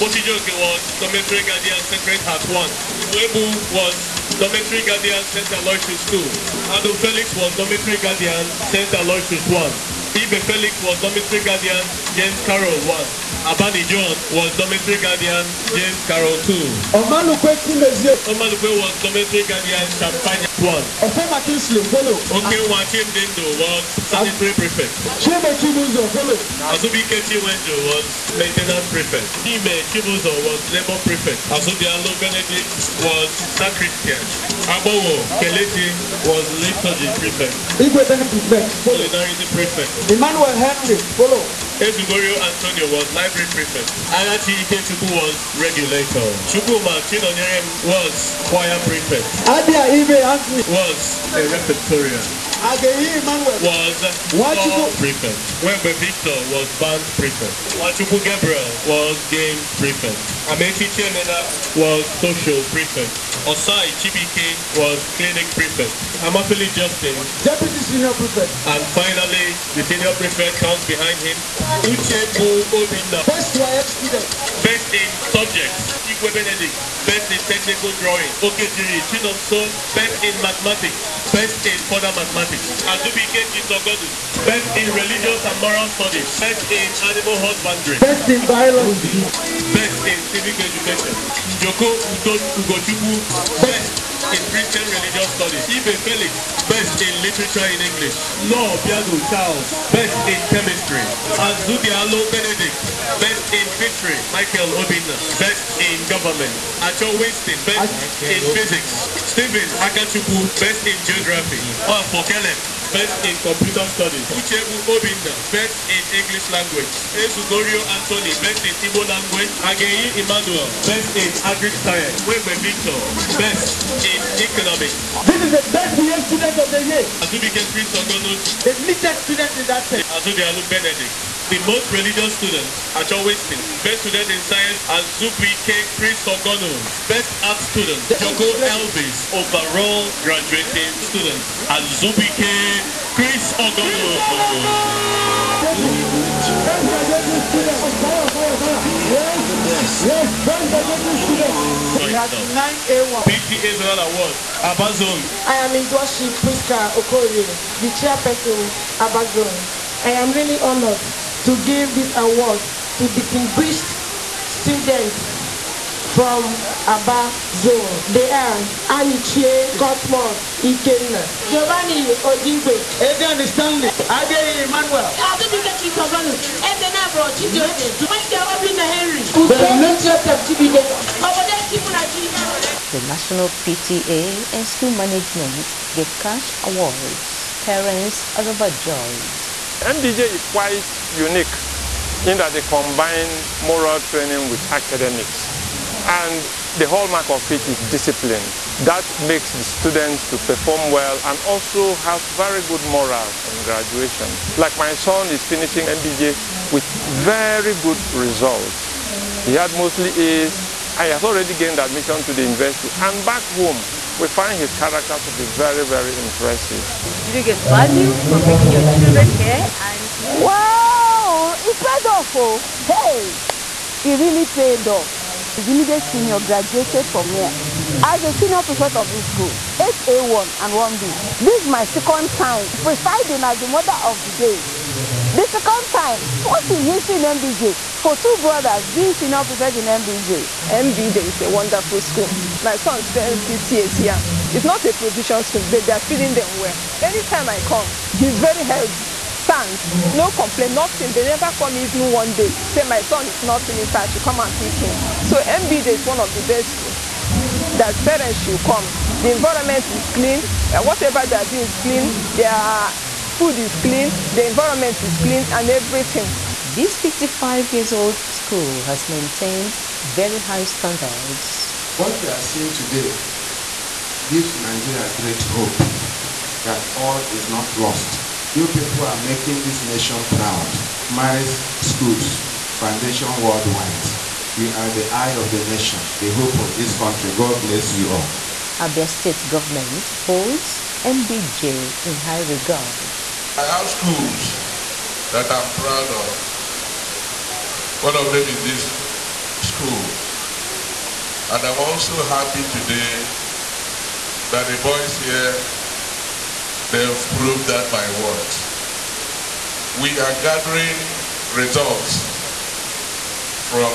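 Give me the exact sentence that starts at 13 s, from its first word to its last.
Abani John was dormitory guardian James Carroll 2.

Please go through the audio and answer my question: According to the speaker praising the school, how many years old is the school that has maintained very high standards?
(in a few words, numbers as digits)
55.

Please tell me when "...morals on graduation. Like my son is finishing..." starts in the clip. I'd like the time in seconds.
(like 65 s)
202 s.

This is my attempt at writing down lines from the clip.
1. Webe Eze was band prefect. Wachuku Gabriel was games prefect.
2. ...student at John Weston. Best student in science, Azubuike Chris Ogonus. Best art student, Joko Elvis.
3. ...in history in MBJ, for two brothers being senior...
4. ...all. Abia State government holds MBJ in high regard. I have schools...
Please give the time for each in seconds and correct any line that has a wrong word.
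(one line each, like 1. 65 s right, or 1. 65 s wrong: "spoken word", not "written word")
1. 55 s wrong: "Victor", not "Eze"
2. 132 s right
3. 236 s right
4. 288 s right.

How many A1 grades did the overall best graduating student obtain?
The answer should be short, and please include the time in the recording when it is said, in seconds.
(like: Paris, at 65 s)
9, at 152 s.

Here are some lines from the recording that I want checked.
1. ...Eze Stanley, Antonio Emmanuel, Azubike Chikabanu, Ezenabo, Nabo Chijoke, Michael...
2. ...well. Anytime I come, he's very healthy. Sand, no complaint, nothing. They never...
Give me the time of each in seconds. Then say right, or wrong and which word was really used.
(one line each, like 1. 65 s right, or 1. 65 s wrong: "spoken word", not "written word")
1. 173 s wrong: "Age", not "Antonio"
2. 246 s right.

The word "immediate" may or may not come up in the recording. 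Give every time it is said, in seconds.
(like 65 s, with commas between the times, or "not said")
225 s.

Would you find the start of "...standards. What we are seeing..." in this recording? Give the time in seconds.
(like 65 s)
270 s.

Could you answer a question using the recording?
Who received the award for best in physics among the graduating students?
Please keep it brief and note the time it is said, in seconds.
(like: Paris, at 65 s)
Stephen Akachukwu, at 109 s.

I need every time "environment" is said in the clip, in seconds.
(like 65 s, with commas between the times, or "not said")
259 s, 264 s.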